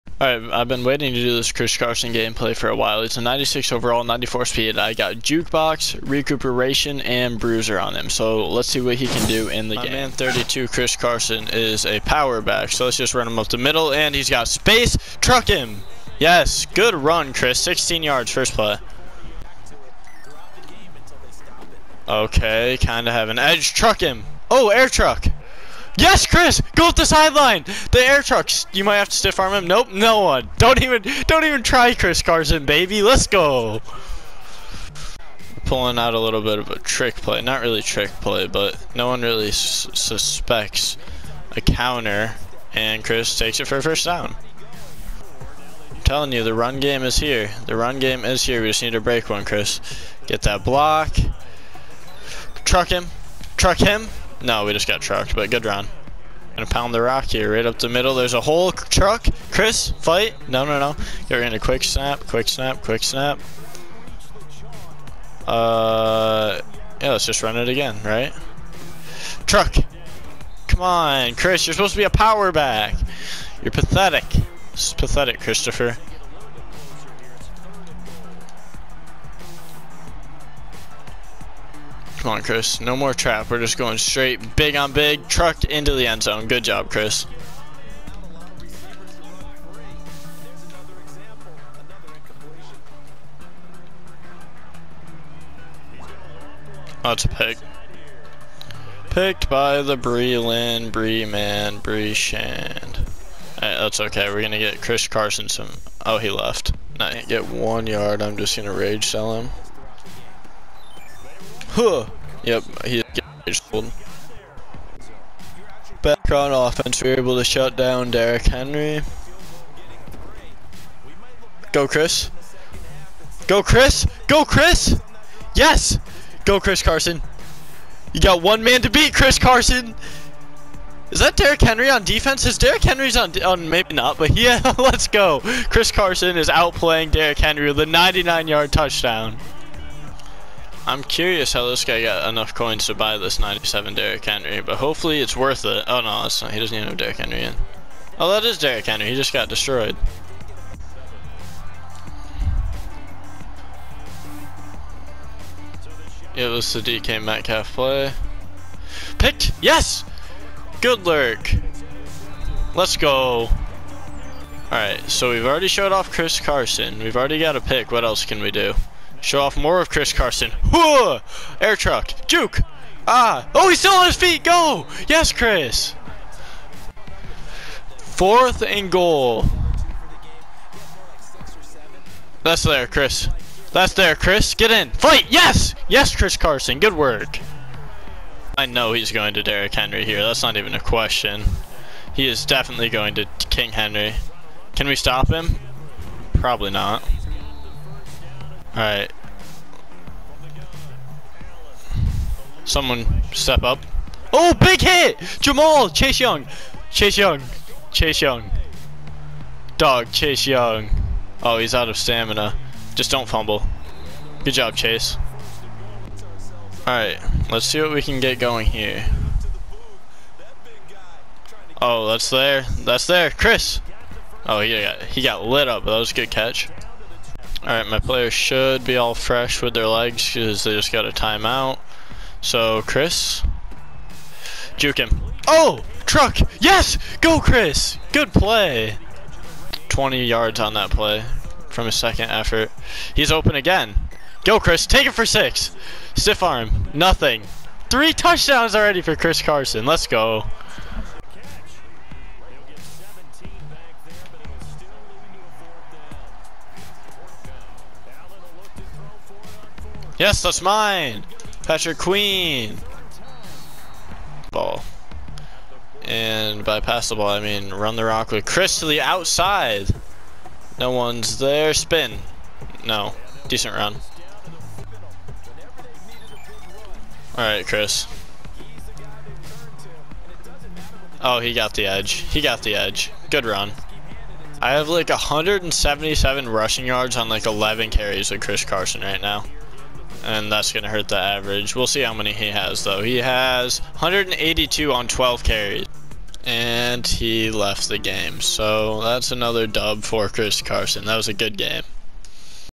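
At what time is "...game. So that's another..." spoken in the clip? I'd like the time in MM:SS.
04:57.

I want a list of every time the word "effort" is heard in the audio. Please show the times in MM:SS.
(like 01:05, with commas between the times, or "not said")
04:02.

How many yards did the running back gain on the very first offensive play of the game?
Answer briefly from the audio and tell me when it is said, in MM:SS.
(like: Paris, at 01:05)
16, at 00:17.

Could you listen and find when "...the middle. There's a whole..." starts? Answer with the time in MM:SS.
00:57.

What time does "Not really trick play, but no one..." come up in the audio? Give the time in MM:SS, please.
00:37.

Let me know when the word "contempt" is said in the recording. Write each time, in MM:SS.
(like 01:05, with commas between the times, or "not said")
not said.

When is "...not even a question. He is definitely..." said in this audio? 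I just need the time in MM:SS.
03:10.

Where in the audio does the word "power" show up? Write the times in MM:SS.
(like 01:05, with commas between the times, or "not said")
00:12, 01:12.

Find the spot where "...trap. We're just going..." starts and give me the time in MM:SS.
01:23.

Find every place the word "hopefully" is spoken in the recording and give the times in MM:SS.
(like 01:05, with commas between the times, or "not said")
02:24.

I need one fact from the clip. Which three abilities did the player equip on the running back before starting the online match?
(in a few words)
Jukebox, Recuperation, and Bruiser.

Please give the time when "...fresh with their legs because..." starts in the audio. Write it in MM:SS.
03:49.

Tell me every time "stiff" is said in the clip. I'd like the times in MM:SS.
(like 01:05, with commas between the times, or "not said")
00:29, 04:06.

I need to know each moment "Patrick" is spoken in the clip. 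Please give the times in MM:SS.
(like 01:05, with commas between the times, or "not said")
04:21.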